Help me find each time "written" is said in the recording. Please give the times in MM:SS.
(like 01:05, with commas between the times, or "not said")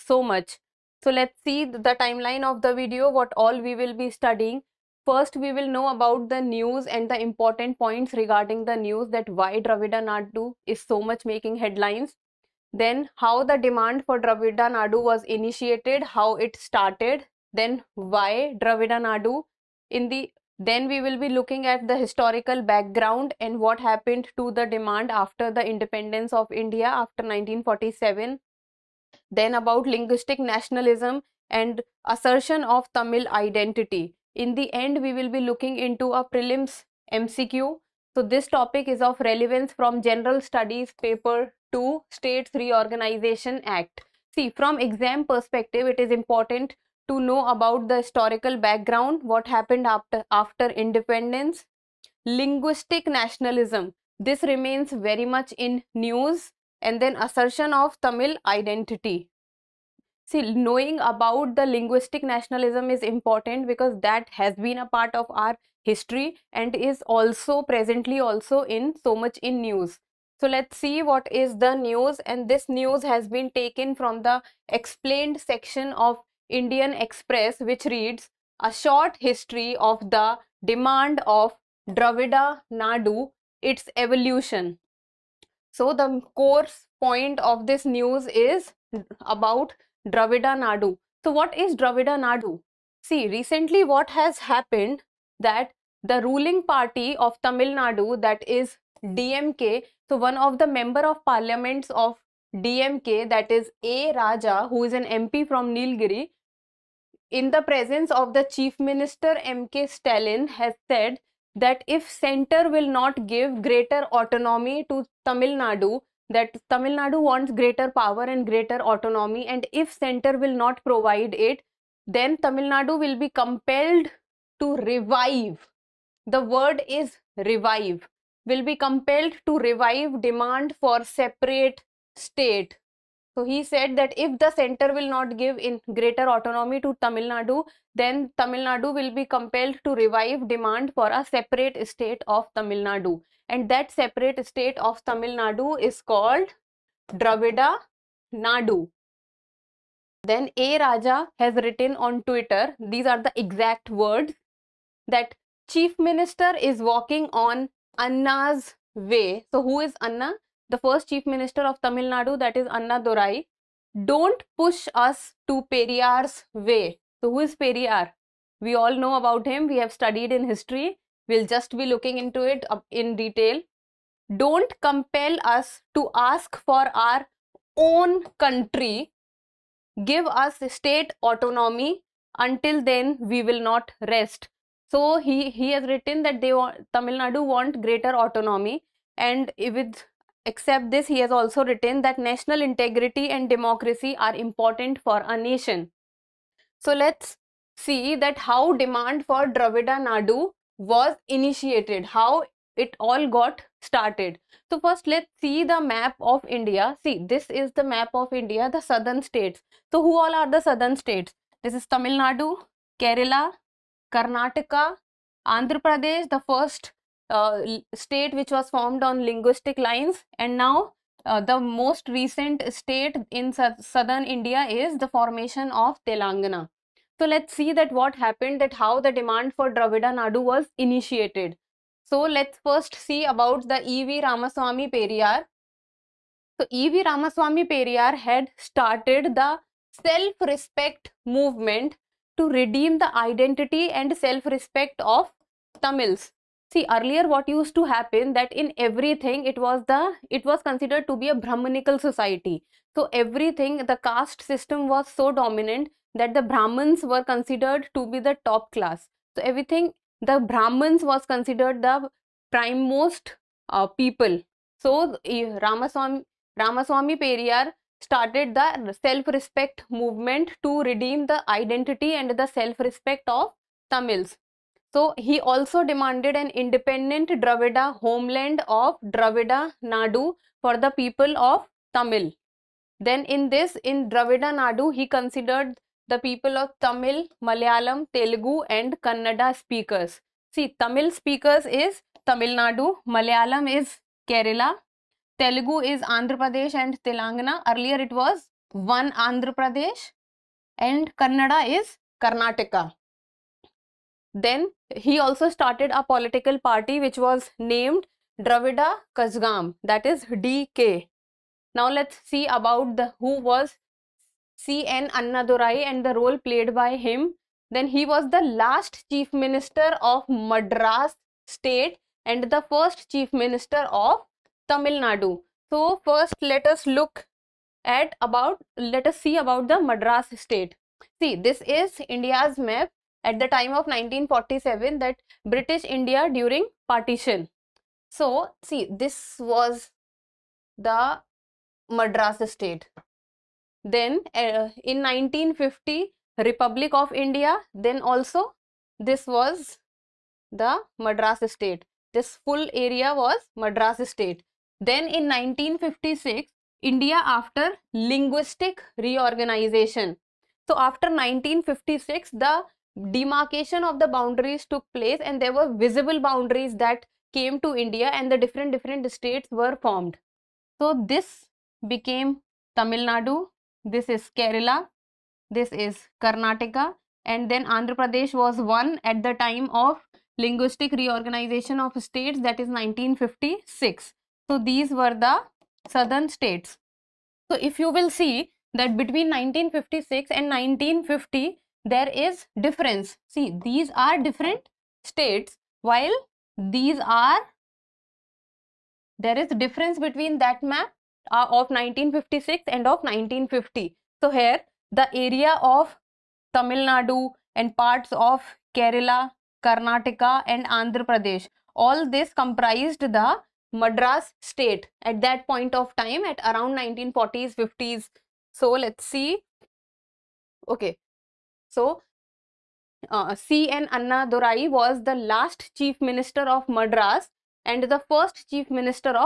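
02:31, 03:05, 03:11.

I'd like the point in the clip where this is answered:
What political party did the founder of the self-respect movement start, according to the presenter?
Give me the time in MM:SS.
05:08.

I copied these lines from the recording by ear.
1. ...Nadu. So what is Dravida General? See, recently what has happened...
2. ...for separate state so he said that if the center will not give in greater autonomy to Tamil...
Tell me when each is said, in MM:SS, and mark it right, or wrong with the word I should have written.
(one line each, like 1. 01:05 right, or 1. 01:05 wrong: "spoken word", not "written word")
1. 01:30 wrong: "Nadu", not "General"
2. 02:10 right.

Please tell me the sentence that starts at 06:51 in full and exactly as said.
All this comprised the Madras state at that point of time at around 1940s, 50s.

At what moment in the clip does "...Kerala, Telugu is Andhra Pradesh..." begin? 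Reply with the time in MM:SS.
04:54.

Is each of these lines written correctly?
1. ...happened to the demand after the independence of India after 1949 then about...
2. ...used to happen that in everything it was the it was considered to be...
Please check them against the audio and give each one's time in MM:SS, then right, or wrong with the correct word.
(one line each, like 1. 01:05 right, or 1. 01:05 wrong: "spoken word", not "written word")
1. 00:23 wrong: "1947", not "1949"
2. 04:07 right.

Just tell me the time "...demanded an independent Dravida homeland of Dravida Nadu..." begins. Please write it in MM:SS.
04:35.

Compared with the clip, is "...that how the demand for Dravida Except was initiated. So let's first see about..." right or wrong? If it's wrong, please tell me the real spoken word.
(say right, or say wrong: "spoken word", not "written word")
wrong: "Nadu", not "Except".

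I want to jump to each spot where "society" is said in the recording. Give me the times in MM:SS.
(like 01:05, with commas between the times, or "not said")
04:12.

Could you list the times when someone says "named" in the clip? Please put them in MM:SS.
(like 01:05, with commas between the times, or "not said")
05:07.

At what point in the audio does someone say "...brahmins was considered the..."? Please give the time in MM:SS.
04:20.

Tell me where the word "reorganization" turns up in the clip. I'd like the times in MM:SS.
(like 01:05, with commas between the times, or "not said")
00:42, 05:58, 06:20.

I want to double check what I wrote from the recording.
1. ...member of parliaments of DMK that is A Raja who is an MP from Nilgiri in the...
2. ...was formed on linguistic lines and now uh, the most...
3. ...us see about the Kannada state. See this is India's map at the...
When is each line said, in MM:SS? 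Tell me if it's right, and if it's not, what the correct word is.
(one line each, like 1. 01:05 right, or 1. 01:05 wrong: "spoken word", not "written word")
1. 01:40 right
2. 03:38 right
3. 05:29 wrong: "Madras", not "Kannada".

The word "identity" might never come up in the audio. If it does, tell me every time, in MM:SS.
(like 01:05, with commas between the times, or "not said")
00:33, 00:58, 04:03, 04:31.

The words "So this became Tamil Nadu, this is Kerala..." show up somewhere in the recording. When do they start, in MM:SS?
06:10.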